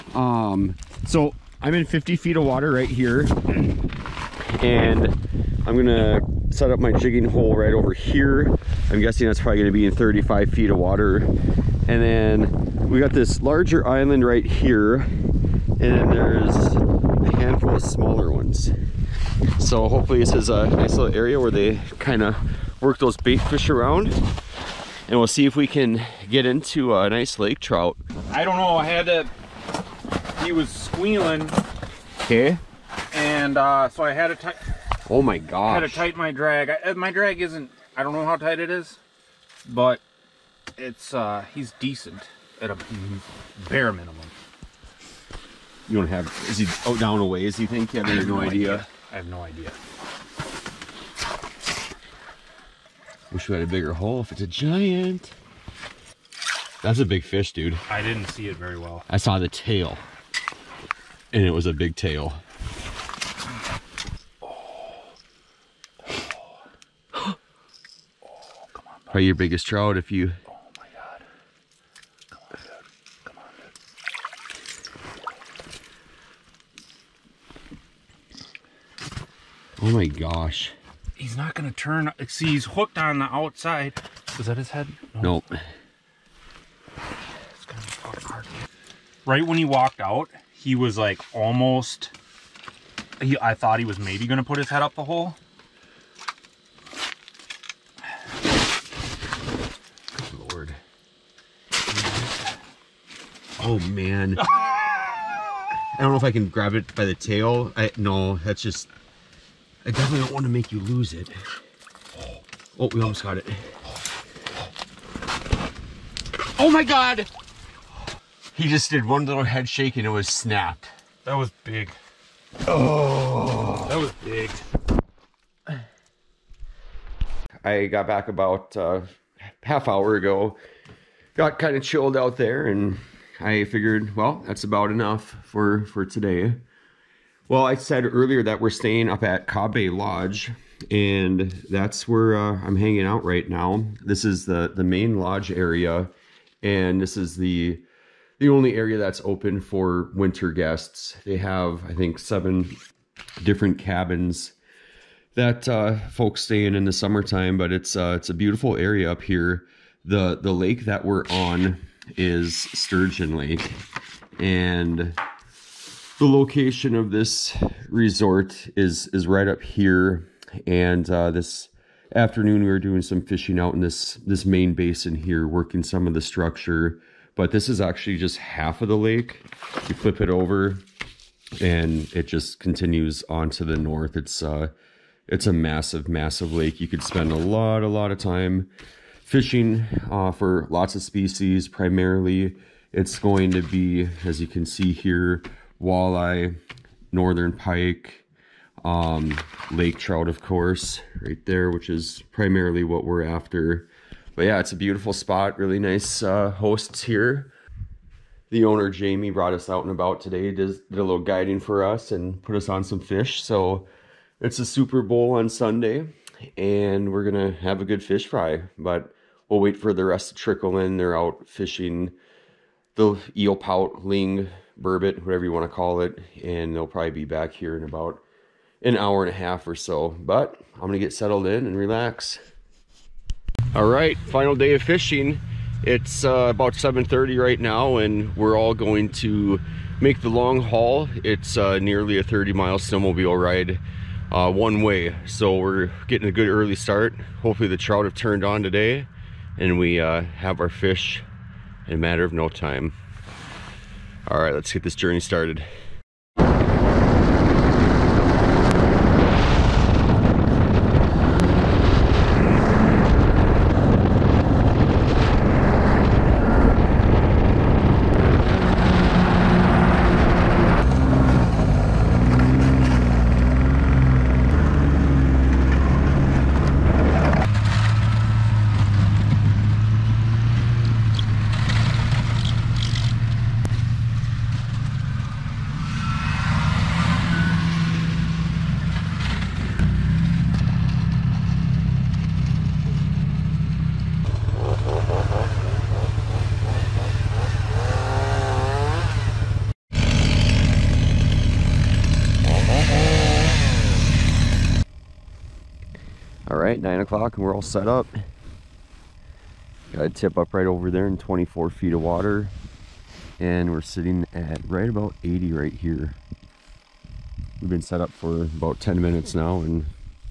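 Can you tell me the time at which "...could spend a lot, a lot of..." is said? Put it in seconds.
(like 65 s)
186 s.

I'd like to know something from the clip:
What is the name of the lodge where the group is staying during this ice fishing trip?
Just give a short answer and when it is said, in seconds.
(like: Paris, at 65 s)
Cobb Bay Lodge, at 139 s.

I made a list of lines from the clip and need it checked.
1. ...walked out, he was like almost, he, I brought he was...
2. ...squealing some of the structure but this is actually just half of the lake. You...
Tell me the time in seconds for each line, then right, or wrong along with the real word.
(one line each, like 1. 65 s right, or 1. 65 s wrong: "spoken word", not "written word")
1. 89 s wrong: "thought", not "brought"
2. 175 s wrong: "working", not "squealing".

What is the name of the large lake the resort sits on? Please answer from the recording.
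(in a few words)
Sturgeon Lake.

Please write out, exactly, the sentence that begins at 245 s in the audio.
So we're getting a good early start.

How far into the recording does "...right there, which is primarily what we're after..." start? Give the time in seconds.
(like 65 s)
201 s.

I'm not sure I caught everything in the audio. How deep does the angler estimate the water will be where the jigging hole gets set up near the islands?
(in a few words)
35 feet.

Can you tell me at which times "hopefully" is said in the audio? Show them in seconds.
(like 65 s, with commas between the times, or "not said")
19 s, 247 s.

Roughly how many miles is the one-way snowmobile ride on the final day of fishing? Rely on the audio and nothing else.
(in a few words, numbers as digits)
30 miles.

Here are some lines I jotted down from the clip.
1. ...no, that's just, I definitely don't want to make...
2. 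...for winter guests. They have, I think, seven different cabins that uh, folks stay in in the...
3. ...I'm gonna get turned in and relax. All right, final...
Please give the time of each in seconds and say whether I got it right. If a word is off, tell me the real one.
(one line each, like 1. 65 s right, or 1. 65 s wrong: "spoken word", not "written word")
1. 107 s right
2. 149 s right
3. 230 s wrong: "settled", not "turned".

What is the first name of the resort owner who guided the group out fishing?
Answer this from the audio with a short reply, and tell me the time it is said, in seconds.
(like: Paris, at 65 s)
Jamie, at 208 s.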